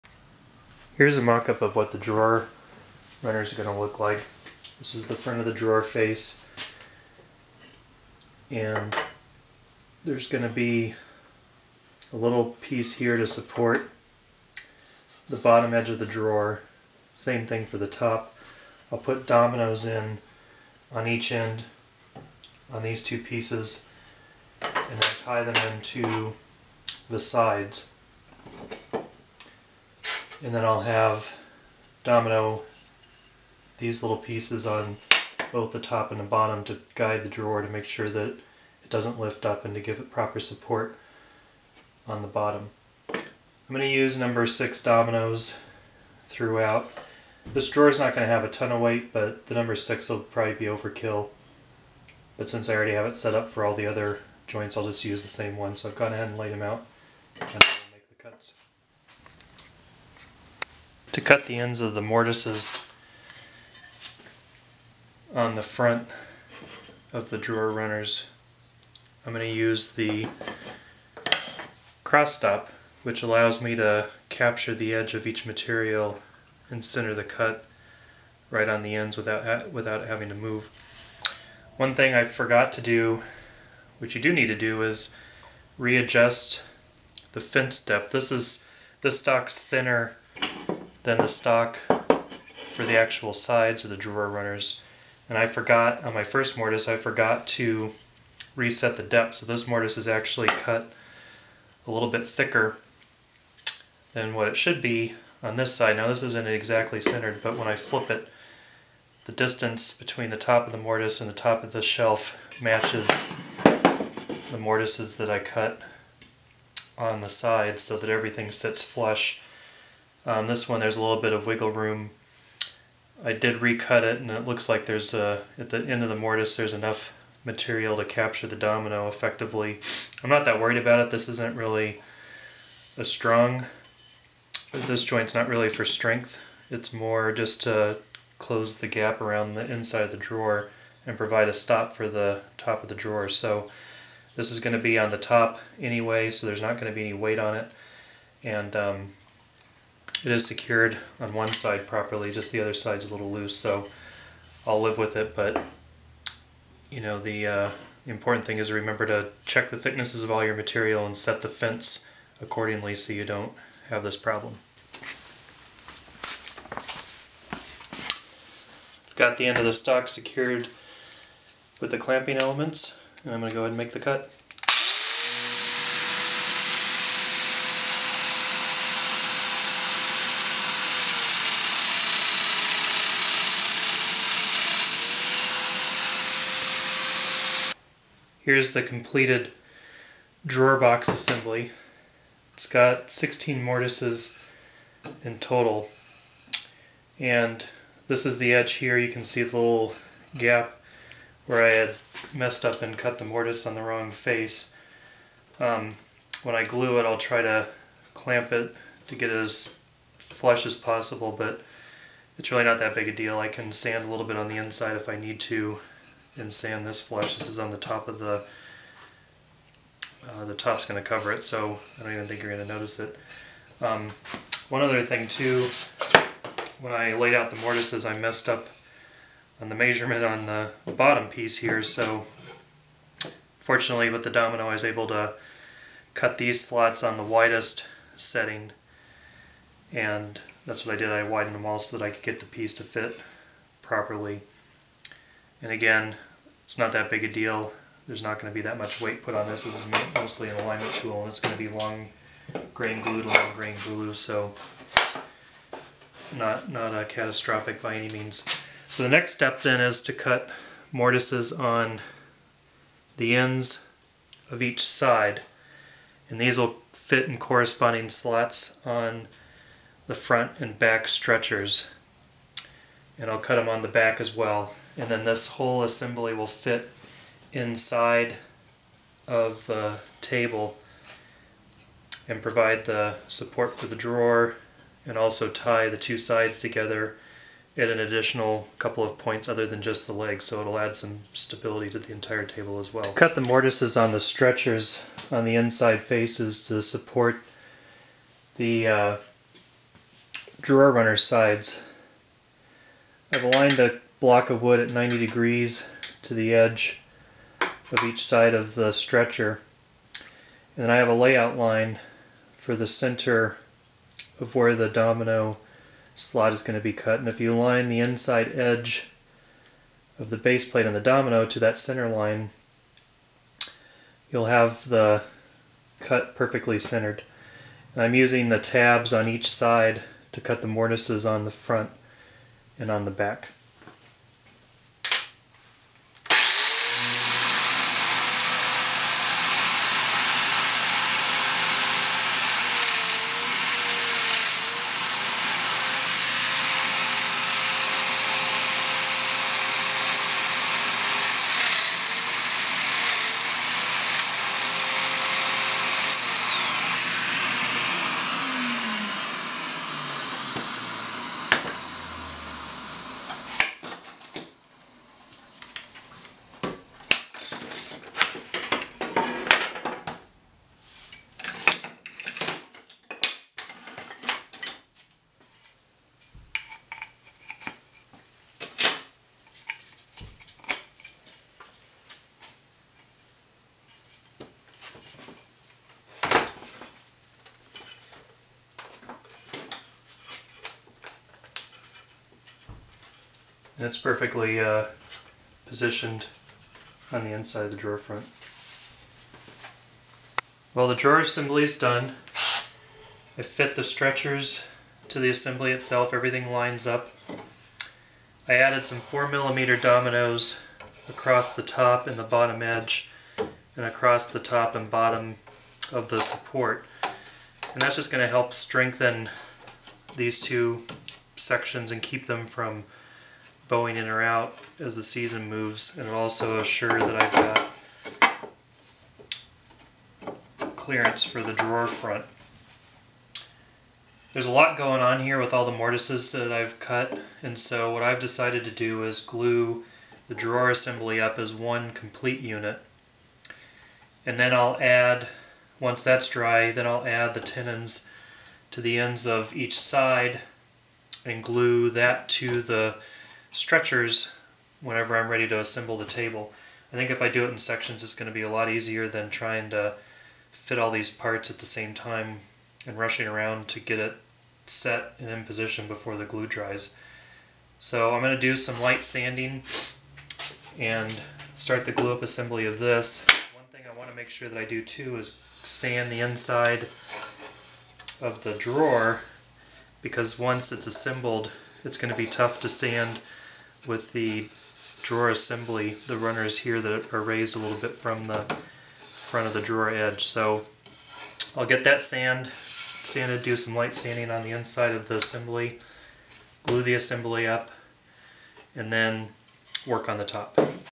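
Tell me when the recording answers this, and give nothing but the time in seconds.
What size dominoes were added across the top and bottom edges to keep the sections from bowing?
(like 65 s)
408 s.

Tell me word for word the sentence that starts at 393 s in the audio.
And it's perfectly uh, positioned on the inside of the drawer front.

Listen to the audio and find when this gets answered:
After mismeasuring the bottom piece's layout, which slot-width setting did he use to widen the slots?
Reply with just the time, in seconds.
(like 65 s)
237 s.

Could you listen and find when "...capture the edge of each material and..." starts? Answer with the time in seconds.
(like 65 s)
74 s.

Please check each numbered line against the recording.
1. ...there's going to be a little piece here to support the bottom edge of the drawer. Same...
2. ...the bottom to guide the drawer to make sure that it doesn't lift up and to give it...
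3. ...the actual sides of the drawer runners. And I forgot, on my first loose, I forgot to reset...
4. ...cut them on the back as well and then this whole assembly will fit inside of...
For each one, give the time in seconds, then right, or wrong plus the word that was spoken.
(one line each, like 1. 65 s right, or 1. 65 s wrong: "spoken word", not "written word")
1. 10 s right
2. 36 s right
3. 92 s wrong: "mortise", not "loose"
4. 273 s right.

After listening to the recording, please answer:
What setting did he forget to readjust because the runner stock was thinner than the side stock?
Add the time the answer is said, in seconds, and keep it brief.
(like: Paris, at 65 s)
fence depth, at 87 s.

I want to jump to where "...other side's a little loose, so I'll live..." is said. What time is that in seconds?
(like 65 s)
152 s.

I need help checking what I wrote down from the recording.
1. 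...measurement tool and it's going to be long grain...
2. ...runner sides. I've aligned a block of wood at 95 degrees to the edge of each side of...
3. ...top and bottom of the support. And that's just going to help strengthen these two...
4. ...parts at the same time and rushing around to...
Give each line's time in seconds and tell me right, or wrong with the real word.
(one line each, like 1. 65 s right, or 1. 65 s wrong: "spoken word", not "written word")
1. 250 s wrong: "alignment", not "measurement"
2. 300 s wrong: "90", not "95"
3. 414 s right
4. 461 s right.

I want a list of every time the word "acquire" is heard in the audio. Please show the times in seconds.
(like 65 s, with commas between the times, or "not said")
not said.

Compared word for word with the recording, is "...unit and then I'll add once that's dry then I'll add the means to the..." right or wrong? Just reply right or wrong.
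wrong.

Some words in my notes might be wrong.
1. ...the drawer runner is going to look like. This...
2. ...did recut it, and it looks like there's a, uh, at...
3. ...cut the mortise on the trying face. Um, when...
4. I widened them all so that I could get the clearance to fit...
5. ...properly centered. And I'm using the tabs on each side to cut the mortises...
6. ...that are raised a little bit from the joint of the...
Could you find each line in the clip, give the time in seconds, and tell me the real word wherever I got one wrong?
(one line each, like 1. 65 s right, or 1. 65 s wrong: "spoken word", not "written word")
1. 1 s right
2. 123 s right
3. 202 s wrong: "wrong", not "trying"
4. 241 s wrong: "piece", not "clearance"
5. 326 s wrong: "perfectly", not "properly"
6. 486 s wrong: "front", not "joint".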